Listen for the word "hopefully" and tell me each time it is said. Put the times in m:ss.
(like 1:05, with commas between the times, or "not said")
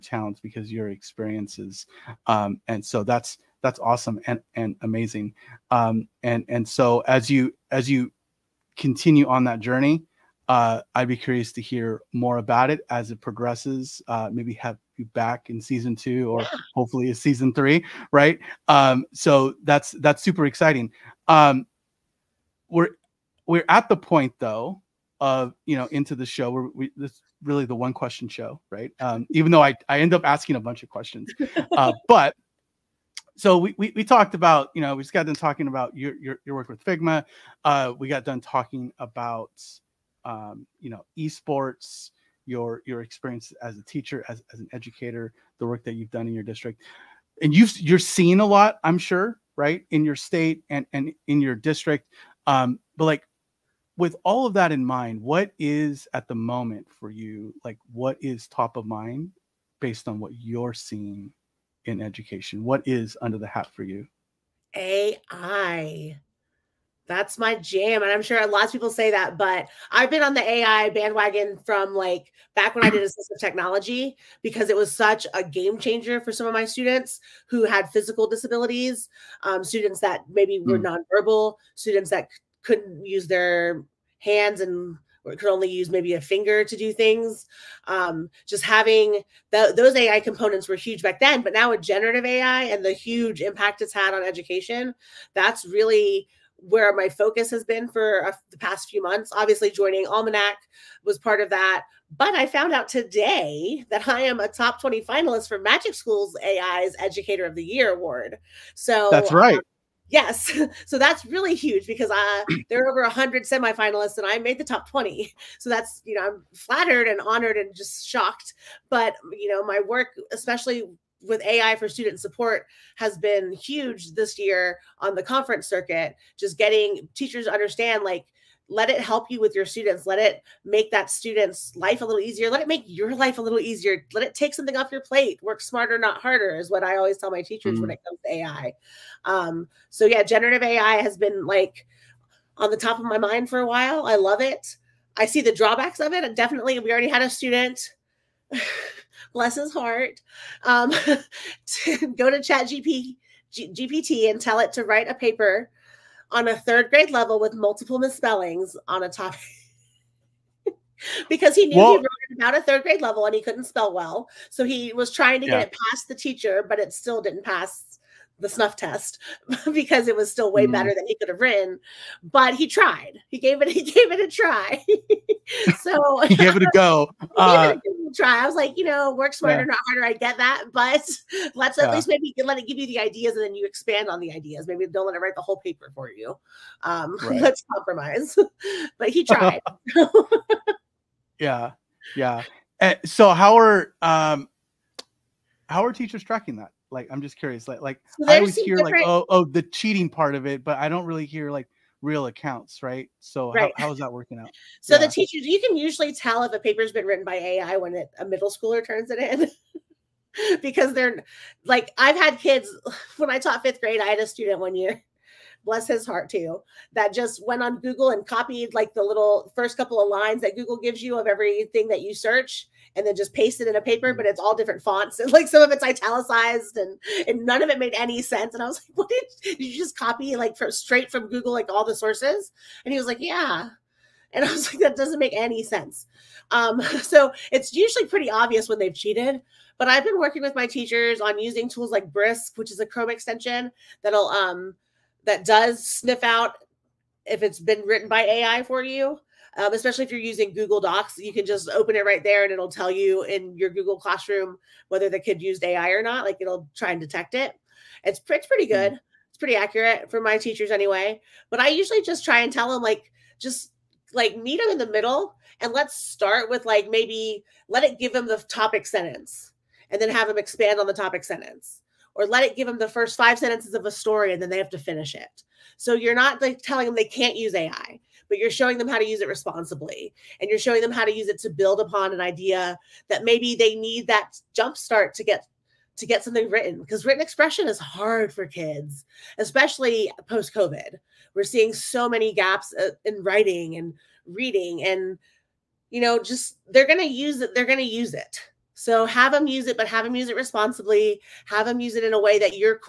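0:16.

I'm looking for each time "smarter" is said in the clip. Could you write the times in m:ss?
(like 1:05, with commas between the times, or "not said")
2:15, 2:59.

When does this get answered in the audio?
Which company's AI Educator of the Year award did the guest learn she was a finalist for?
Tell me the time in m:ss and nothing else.
1:45.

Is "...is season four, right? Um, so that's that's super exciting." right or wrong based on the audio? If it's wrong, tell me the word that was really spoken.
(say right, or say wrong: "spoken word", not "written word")
wrong: "three", not "four".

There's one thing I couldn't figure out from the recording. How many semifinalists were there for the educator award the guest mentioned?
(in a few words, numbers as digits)
over 100.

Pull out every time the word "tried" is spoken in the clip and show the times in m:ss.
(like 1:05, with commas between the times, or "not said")
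2:52, 3:09.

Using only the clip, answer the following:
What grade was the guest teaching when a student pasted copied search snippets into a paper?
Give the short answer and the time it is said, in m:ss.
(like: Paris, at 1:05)
fifth grade, at 3:33.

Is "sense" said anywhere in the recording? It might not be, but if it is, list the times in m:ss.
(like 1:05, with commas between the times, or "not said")
3:48, 3:55.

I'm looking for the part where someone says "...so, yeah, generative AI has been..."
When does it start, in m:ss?
2:19.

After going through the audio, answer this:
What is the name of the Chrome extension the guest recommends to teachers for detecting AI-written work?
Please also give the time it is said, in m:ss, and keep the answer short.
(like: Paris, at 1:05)
Brisk, at 4:02.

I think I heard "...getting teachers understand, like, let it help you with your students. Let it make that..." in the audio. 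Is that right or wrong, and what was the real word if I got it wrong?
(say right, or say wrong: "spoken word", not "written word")
right.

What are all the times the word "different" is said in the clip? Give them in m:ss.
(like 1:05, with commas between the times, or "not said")
3:18, 3:44.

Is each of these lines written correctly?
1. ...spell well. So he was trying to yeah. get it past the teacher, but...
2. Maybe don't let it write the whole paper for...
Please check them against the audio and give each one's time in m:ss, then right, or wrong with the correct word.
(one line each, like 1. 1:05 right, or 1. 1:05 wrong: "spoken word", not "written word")
1. 2:43 right
2. 3:04 right.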